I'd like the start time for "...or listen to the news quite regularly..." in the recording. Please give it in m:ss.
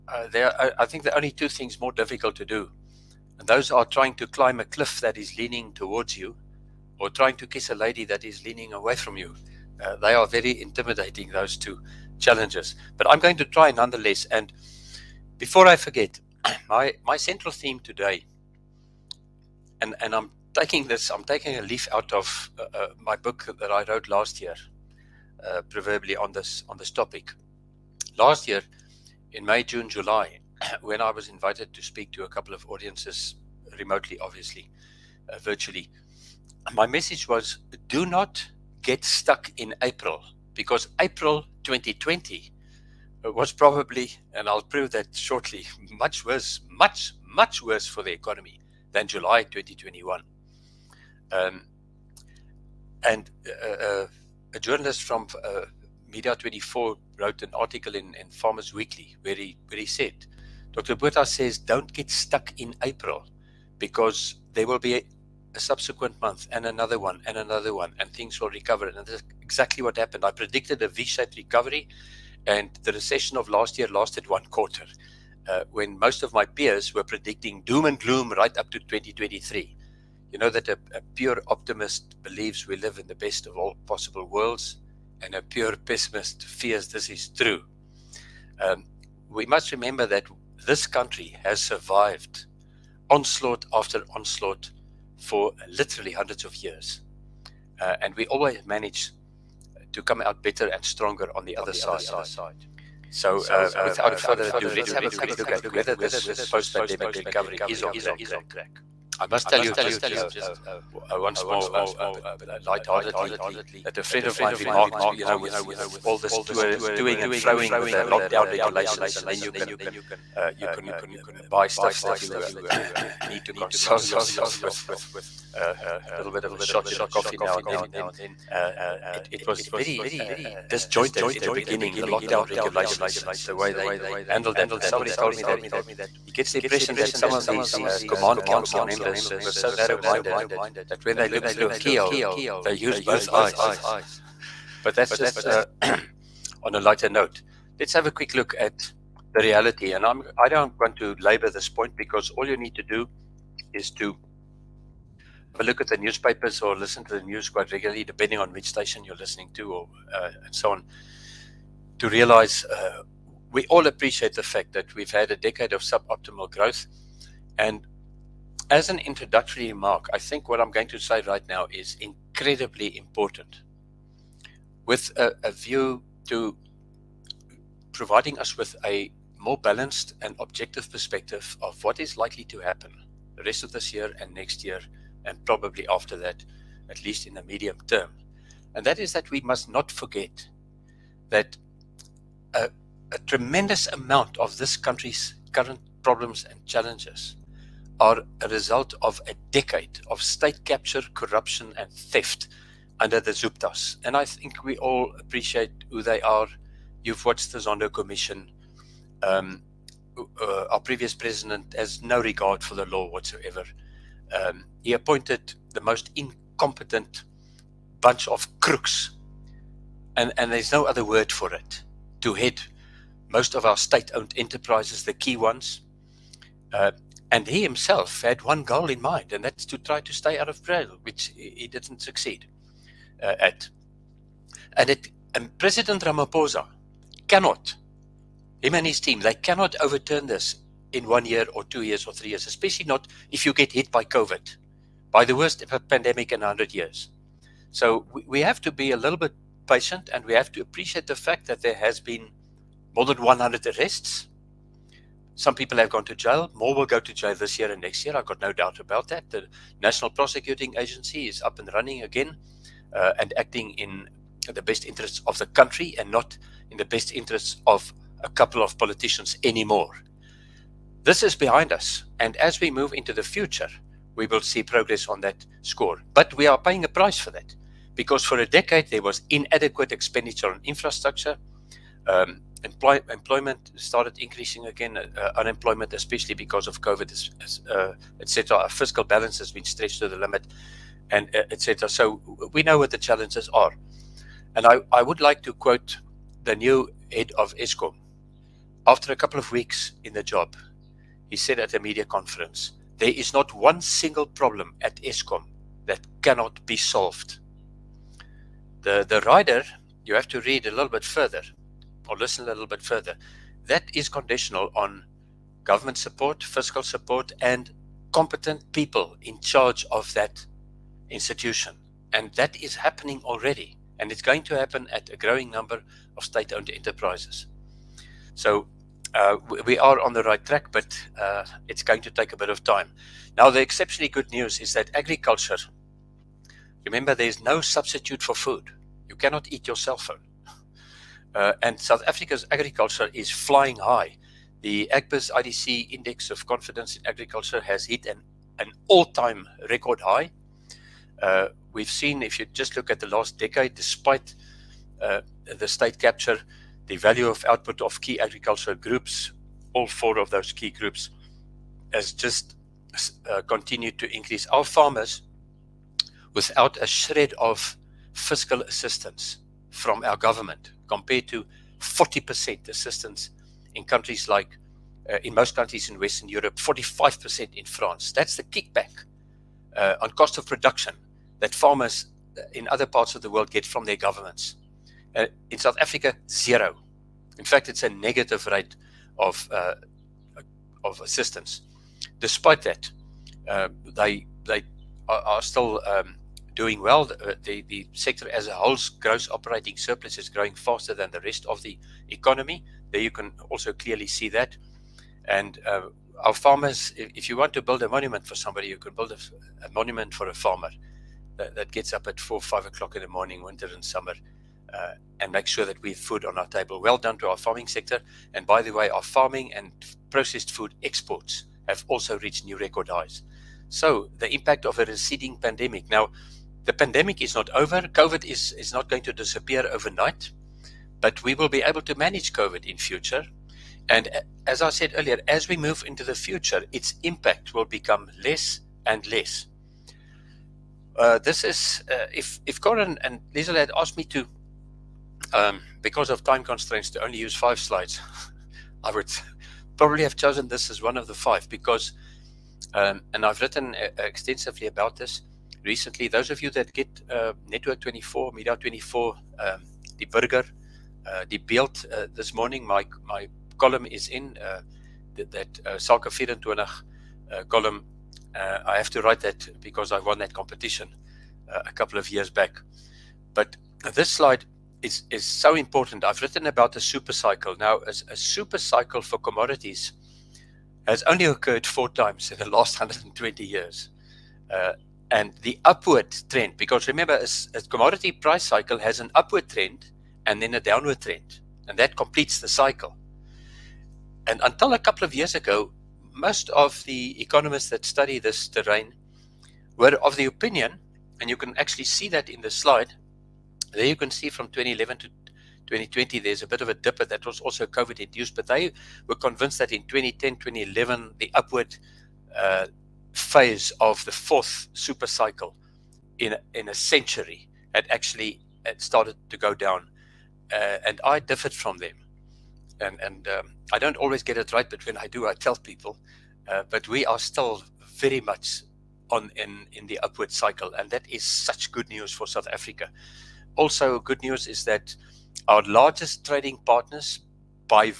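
2:36.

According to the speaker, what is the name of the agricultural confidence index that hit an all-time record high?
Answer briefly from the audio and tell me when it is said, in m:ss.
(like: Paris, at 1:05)
Agbiz IDC Index, at 5:44.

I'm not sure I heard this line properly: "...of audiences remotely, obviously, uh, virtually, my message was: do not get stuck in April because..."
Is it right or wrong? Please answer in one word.
right.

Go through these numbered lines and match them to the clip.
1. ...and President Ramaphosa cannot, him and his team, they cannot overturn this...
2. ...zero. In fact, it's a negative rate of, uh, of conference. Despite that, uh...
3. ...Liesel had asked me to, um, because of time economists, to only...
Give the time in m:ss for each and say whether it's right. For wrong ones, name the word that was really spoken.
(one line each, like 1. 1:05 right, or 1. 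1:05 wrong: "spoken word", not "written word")
1. 3:55 right
2. 6:26 wrong: "assistance", not "conference"
3. 7:23 wrong: "constraints", not "economists".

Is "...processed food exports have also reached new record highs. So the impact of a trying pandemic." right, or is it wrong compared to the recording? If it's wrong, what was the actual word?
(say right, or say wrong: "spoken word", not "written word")
wrong: "receding", not "trying".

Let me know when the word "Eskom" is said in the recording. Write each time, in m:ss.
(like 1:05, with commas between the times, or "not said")
4:57, 5:04.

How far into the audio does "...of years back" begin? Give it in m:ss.
7:51.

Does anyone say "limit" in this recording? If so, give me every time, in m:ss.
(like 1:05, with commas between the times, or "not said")
4:50.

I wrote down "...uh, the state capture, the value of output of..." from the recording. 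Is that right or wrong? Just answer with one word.
right.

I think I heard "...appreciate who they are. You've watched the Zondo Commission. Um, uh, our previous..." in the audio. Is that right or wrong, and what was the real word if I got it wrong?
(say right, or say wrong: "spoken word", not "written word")
right.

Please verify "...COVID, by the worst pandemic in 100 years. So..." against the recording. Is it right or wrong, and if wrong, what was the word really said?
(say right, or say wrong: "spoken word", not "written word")
right.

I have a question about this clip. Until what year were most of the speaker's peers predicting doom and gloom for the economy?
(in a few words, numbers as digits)
2023.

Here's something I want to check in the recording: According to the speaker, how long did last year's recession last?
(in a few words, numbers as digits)
One quarter.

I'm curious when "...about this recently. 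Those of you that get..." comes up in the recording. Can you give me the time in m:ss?
7:34.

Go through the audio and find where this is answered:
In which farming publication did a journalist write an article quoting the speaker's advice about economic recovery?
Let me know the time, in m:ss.
0:58.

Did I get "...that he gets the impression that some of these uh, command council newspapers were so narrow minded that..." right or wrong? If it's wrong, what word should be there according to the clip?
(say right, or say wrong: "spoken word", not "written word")
wrong: "members", not "newspapers".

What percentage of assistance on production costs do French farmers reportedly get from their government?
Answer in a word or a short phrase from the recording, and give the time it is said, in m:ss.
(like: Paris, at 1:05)
45%, at 6:16.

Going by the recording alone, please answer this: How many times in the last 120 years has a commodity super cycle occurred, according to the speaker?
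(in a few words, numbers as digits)
4.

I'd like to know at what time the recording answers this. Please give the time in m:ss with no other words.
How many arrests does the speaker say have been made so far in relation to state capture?
4:12.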